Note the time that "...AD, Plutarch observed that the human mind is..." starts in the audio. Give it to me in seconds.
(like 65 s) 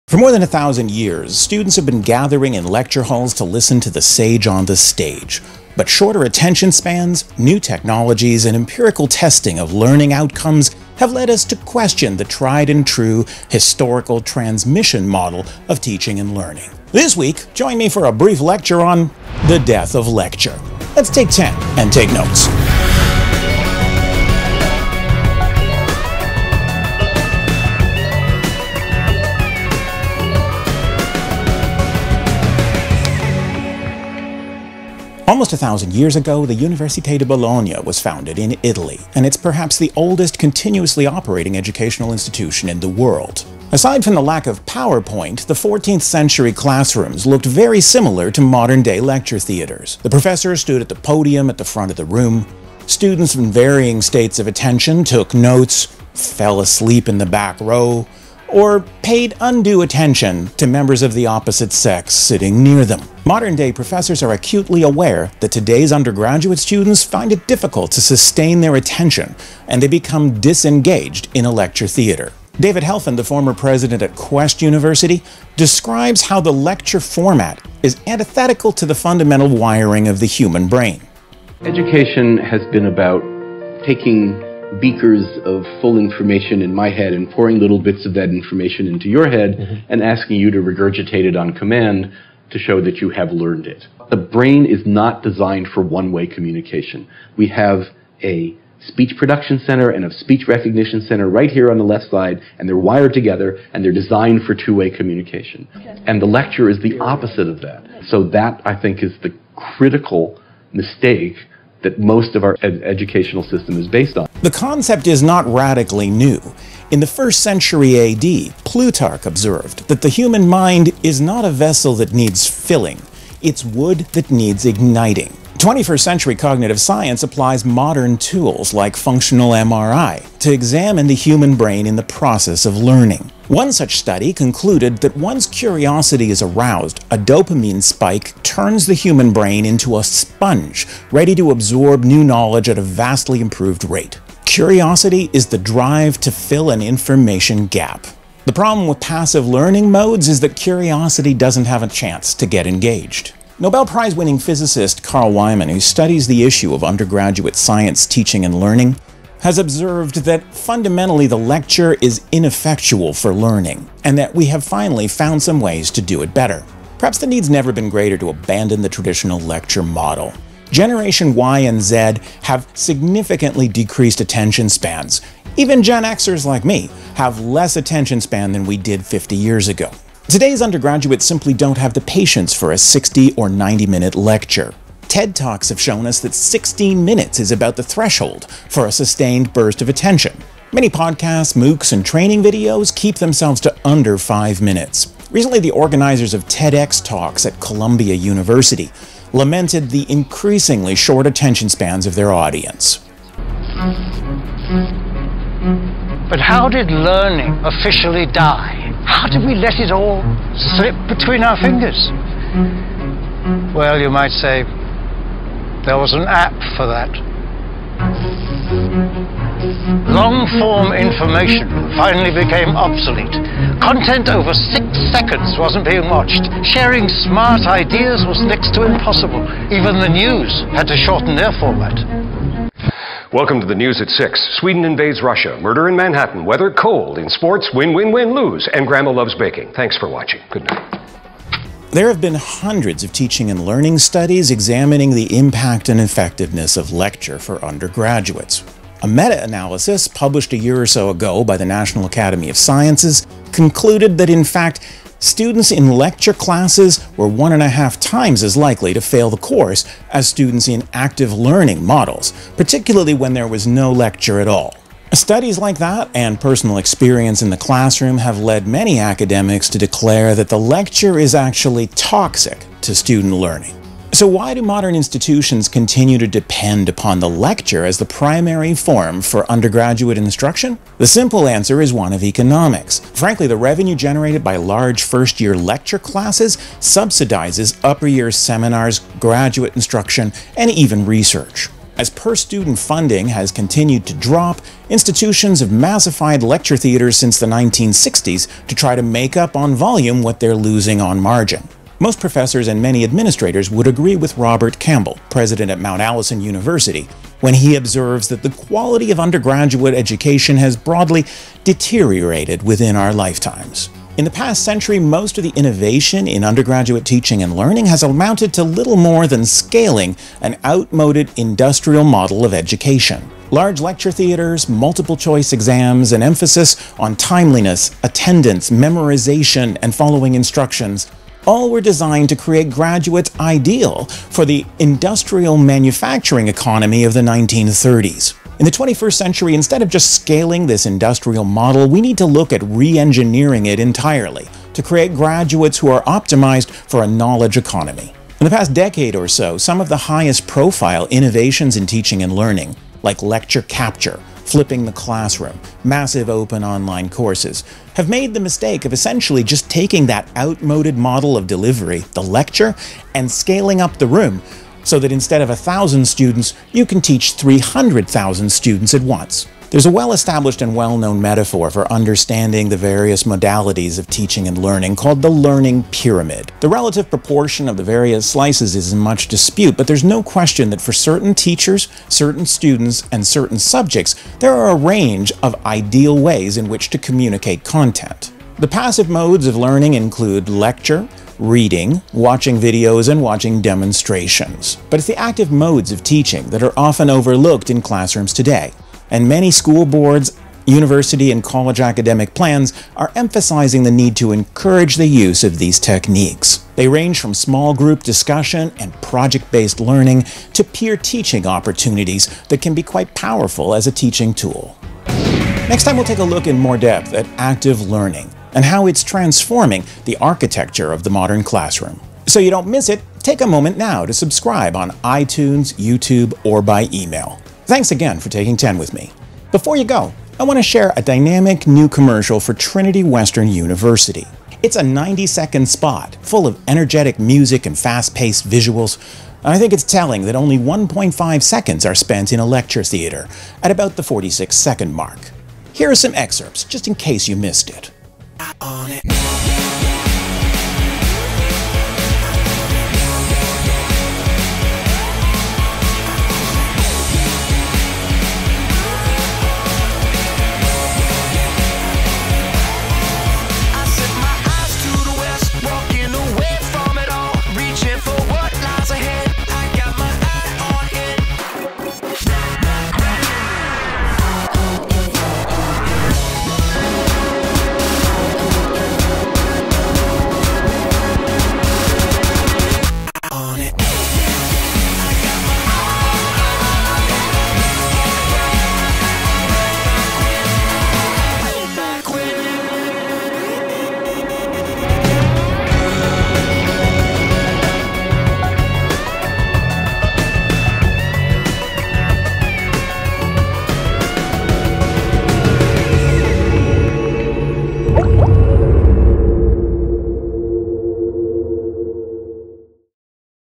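117 s.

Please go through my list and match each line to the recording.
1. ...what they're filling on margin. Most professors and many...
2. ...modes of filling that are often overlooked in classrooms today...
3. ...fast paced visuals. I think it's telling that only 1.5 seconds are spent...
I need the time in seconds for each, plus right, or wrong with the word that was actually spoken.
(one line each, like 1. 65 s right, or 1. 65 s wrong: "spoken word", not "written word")
1. 300 s wrong: "losing", not "filling"
2. 395 s wrong: "teaching", not "filling"
3. 437 s right.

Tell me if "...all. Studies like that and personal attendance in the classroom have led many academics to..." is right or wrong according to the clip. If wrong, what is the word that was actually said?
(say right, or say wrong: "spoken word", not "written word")
wrong: "experience", not "attendance".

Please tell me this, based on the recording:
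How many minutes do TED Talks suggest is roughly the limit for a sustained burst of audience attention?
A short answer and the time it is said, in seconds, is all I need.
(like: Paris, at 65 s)
16 minutes, at 186 s.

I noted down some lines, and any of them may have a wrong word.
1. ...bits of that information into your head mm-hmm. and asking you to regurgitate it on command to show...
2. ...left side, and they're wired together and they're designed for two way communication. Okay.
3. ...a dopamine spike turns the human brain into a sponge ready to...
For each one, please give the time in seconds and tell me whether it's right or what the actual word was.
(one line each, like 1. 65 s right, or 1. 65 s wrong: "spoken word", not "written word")
1. 87 s right
2. 101 s right
3. 137 s right.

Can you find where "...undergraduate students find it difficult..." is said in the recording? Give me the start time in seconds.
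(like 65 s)
65 s.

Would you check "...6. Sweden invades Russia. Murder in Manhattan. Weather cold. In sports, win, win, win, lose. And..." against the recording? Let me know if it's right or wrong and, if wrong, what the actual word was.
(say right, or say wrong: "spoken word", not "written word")
right.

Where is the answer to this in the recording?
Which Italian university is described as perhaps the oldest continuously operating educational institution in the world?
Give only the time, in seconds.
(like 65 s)
36 s.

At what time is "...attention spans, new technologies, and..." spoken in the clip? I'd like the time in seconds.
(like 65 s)
6 s.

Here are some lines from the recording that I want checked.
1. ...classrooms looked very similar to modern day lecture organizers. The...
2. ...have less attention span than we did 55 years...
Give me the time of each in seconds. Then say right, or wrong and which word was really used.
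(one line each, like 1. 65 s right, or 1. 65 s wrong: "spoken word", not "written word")
1. 46 s wrong: "theaters", not "organizers"
2. 177 s wrong: "50", not "55".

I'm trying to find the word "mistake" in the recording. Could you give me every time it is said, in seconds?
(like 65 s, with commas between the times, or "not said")
110 s, 358 s.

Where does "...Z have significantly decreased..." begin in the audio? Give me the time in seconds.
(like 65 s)
171 s.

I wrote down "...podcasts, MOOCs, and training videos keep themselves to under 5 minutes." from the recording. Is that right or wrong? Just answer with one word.
right.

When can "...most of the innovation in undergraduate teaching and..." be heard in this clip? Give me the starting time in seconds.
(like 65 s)
314 s.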